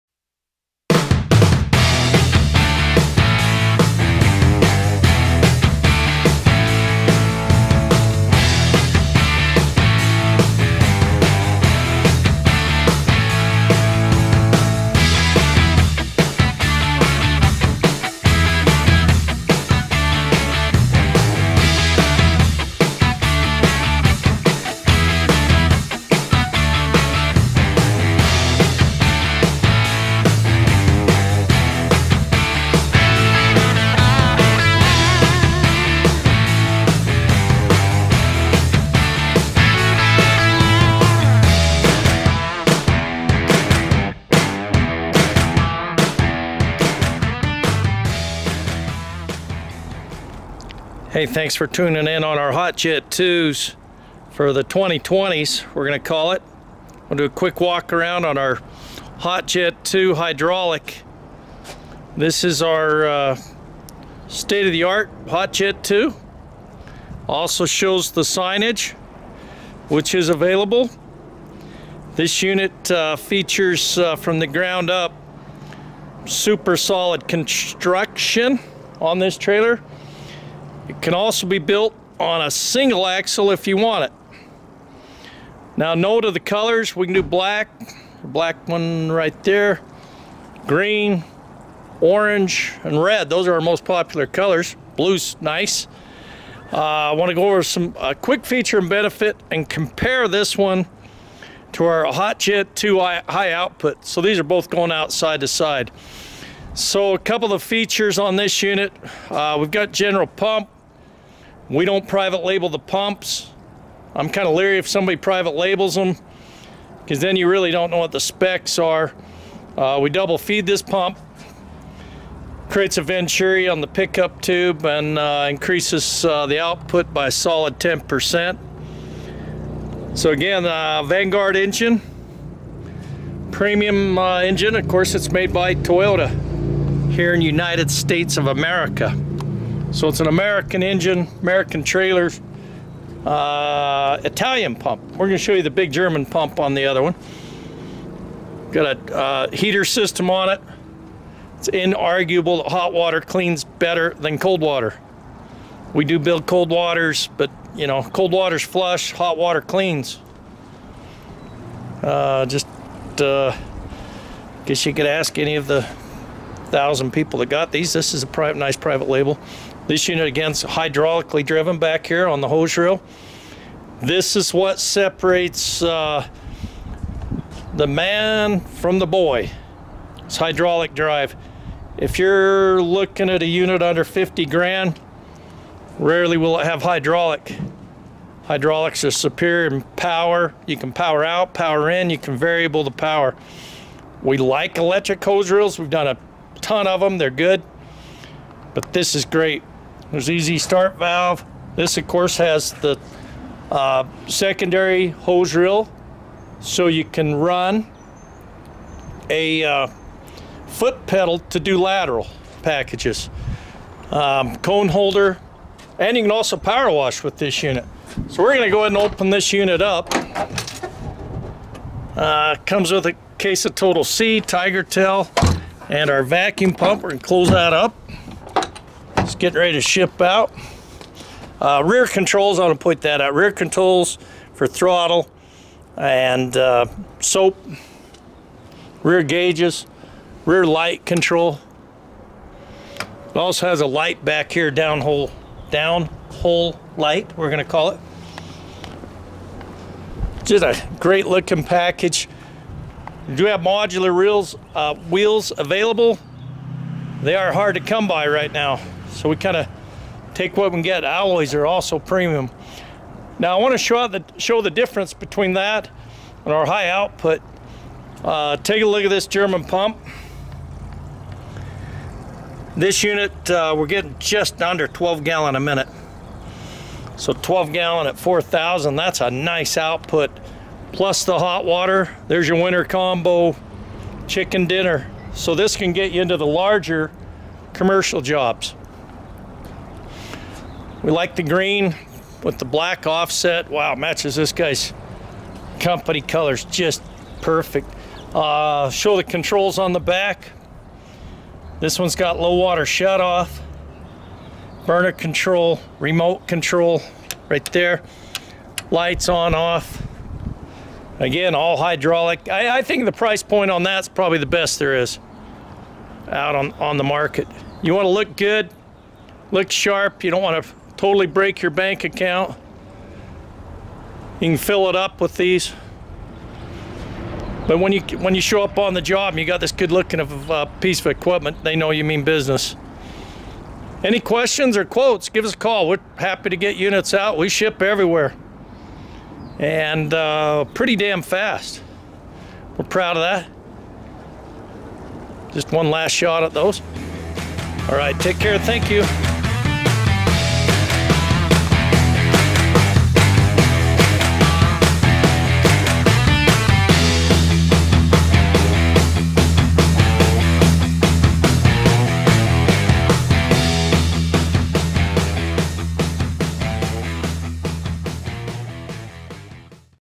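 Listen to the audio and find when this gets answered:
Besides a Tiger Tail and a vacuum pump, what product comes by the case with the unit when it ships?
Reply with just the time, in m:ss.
3:43.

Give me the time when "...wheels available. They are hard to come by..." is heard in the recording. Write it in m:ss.
4:14.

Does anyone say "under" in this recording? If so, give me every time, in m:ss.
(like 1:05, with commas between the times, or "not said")
3:03, 4:34.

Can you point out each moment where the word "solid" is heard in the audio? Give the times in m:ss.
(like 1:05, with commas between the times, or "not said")
1:16, 2:07.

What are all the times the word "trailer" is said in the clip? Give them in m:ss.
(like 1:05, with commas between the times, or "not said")
1:19, 2:21.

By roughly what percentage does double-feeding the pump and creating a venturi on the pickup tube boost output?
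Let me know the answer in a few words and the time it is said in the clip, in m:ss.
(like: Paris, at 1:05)
10%, at 2:07.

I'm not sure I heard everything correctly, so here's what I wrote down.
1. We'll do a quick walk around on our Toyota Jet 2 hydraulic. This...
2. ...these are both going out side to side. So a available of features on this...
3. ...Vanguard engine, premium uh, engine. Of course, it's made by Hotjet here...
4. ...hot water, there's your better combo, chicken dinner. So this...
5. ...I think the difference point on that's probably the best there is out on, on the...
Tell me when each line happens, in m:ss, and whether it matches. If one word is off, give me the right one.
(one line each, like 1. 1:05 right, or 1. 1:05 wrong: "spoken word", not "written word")
1. 0:57 wrong: "Hot", not "Toyota"
2. 1:44 wrong: "couple", not "available"
3. 2:11 wrong: "Toyota", not "Hotjet"
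4. 4:41 wrong: "winter", not "better"
5. 5:12 wrong: "price", not "difference".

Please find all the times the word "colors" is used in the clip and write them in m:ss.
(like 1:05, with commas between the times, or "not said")
1:26, 1:34, 4:56.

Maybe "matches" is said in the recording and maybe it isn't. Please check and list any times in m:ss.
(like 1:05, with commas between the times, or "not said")
4:53.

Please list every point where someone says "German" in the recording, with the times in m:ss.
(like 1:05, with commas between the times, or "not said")
2:25, 4:29.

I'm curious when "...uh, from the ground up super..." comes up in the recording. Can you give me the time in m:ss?
1:13.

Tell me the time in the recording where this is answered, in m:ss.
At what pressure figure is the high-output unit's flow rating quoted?
4:38.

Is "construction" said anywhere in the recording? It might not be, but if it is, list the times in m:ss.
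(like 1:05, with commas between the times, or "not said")
1:17.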